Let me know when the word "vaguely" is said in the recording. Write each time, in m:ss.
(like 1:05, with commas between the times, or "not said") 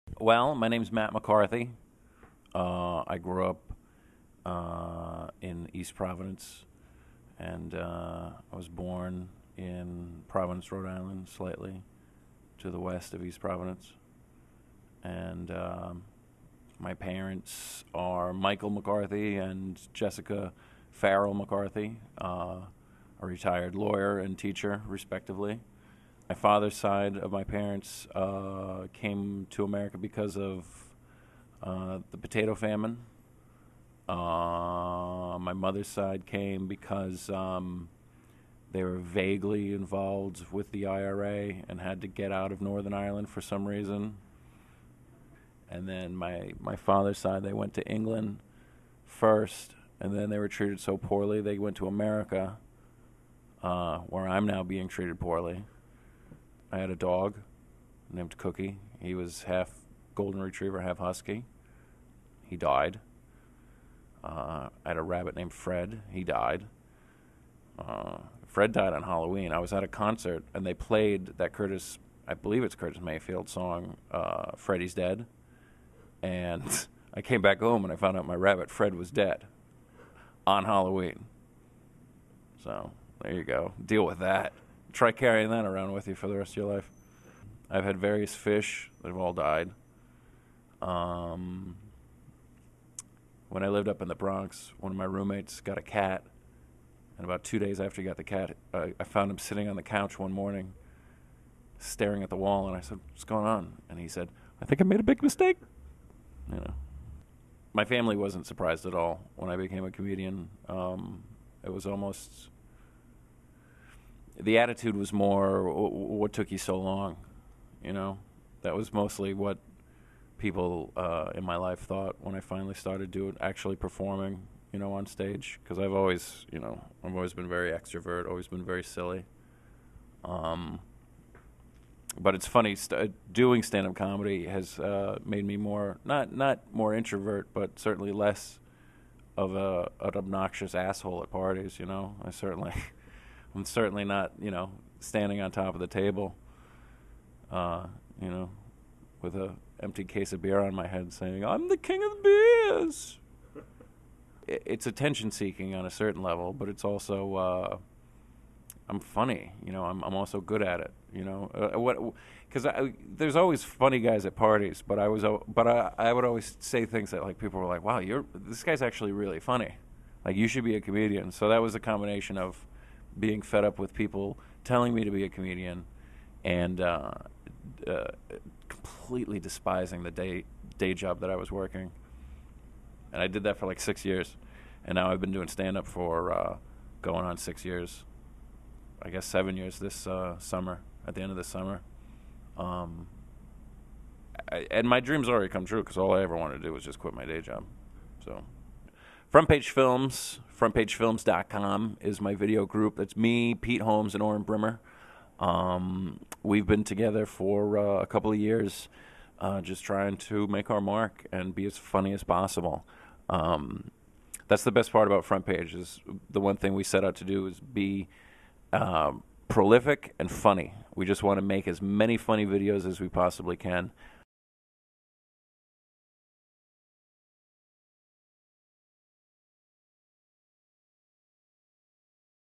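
0:38.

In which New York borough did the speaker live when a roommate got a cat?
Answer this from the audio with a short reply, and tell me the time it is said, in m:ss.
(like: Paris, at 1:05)
the Bronx, at 1:34.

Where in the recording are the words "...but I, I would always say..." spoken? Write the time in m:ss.
2:45.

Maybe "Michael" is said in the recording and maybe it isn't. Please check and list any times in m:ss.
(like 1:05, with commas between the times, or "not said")
0:18.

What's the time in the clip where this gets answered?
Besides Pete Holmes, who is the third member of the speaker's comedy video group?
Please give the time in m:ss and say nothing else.
3:24.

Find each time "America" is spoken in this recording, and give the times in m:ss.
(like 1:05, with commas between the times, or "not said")
0:29, 0:51.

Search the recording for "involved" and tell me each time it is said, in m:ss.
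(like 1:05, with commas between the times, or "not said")
0:39.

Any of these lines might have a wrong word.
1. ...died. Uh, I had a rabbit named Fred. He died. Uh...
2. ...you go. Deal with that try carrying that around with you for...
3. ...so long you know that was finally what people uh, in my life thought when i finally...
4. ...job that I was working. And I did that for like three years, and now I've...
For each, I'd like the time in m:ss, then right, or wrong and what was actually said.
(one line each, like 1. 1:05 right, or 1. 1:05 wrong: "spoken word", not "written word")
1. 1:02 right
2. 1:23 right
3. 1:56 wrong: "mostly", not "finally"
4. 3:00 wrong: "six", not "three".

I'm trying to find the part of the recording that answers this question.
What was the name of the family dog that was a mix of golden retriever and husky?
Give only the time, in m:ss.
0:58.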